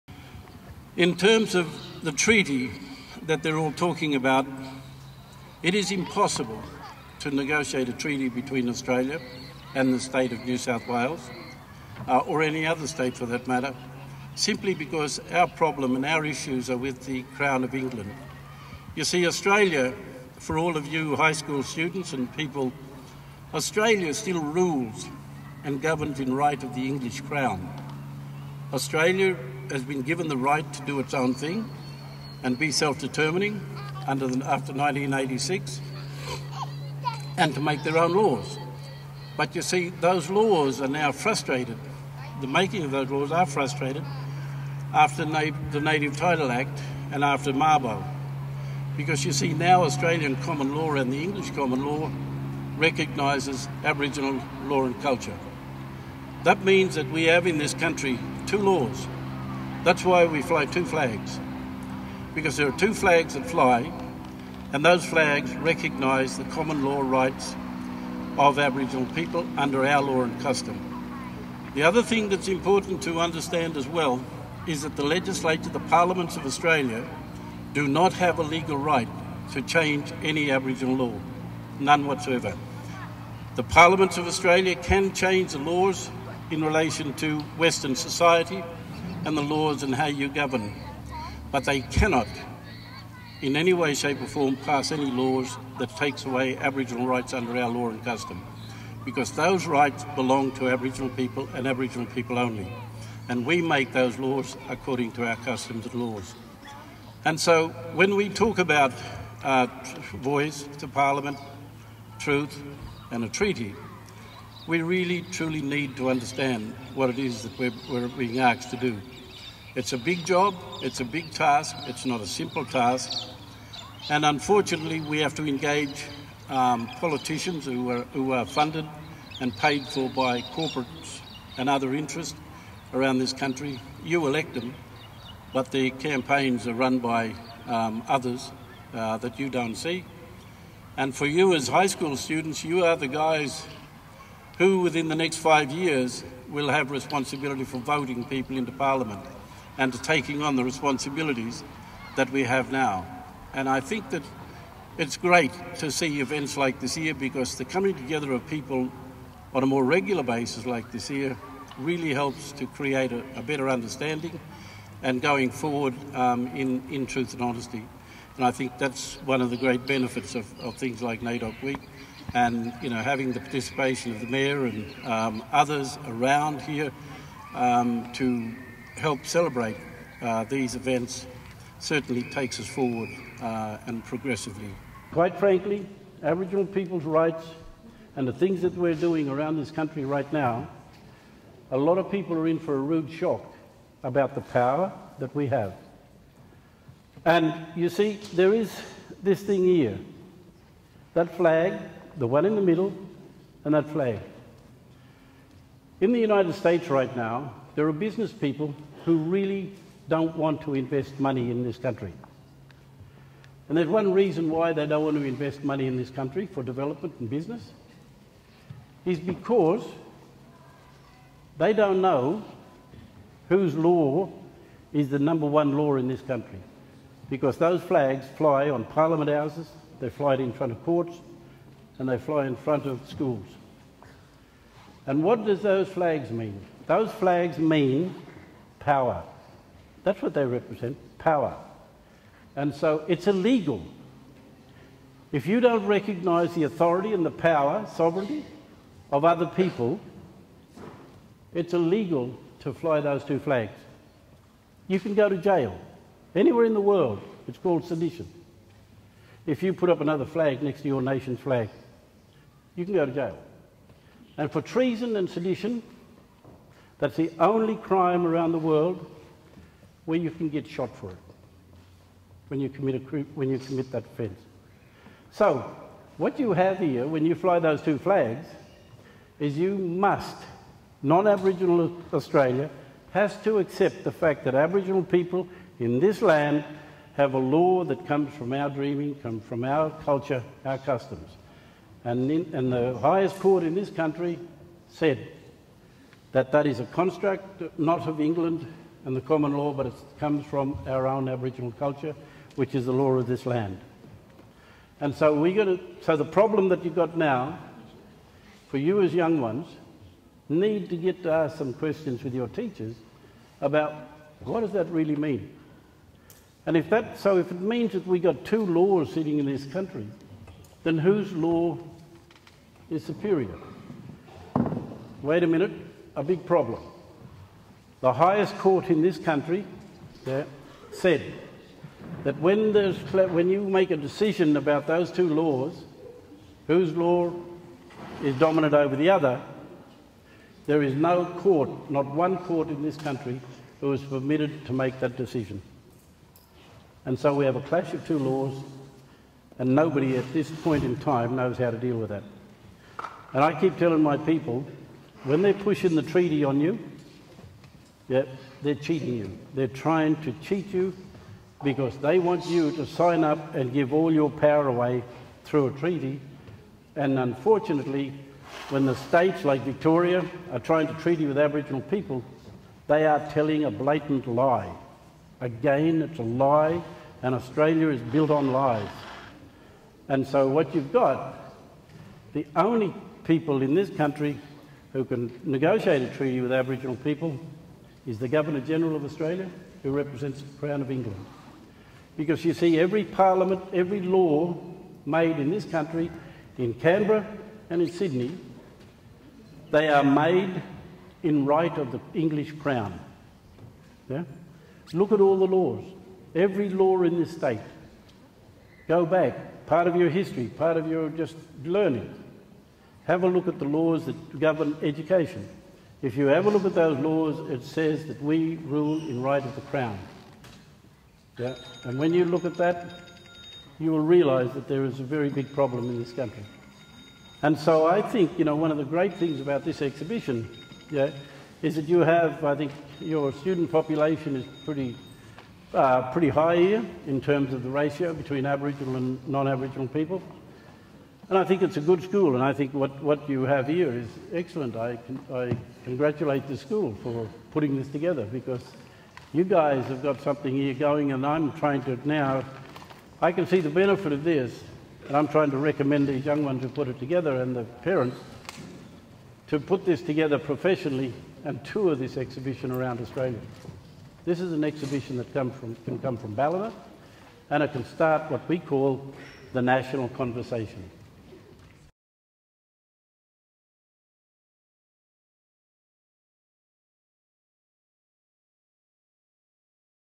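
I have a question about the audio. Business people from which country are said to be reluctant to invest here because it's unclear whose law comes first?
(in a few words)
United States.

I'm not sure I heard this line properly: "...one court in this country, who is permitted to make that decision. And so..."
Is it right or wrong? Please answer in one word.
right.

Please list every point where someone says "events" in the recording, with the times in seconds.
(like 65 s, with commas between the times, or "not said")
156 s, 180 s.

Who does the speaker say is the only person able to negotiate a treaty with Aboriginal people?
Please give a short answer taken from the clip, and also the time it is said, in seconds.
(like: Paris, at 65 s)
the Governor General, at 388 s.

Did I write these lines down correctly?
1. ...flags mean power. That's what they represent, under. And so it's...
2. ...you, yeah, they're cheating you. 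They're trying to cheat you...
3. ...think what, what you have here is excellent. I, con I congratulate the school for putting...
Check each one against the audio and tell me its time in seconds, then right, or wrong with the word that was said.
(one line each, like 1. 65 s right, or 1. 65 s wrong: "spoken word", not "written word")
1. 237 s wrong: "power", not "under"
2. 356 s right
3. 442 s right.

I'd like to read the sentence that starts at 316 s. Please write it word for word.
And if that, so if it means that we got two laws sitting in this country, then whose law is superior.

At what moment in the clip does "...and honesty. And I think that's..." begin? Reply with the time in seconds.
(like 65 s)
167 s.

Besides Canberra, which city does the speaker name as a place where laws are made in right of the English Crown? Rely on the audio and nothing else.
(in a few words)
Sydney.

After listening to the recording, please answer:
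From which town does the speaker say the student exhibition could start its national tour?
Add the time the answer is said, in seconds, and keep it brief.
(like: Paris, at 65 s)
Ballina, at 466 s.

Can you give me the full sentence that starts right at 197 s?
And you see, there is this thing here.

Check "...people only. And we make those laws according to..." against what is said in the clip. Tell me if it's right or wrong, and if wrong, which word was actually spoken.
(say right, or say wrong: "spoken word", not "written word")
right.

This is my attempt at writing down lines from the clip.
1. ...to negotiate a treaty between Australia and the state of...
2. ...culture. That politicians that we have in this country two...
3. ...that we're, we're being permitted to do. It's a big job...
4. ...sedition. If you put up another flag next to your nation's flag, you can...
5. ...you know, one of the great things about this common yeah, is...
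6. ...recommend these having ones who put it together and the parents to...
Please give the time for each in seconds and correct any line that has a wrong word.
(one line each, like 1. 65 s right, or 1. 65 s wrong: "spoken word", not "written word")
1. 7 s right
2. 55 s wrong: "means", not "politicians"
3. 117 s wrong: "asked", not "permitted"
4. 257 s right
5. 428 s wrong: "exhibition", not "common"
6. 455 s wrong: "young", not "having".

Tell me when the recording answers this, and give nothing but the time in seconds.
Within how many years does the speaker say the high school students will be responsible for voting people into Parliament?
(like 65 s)
145 s.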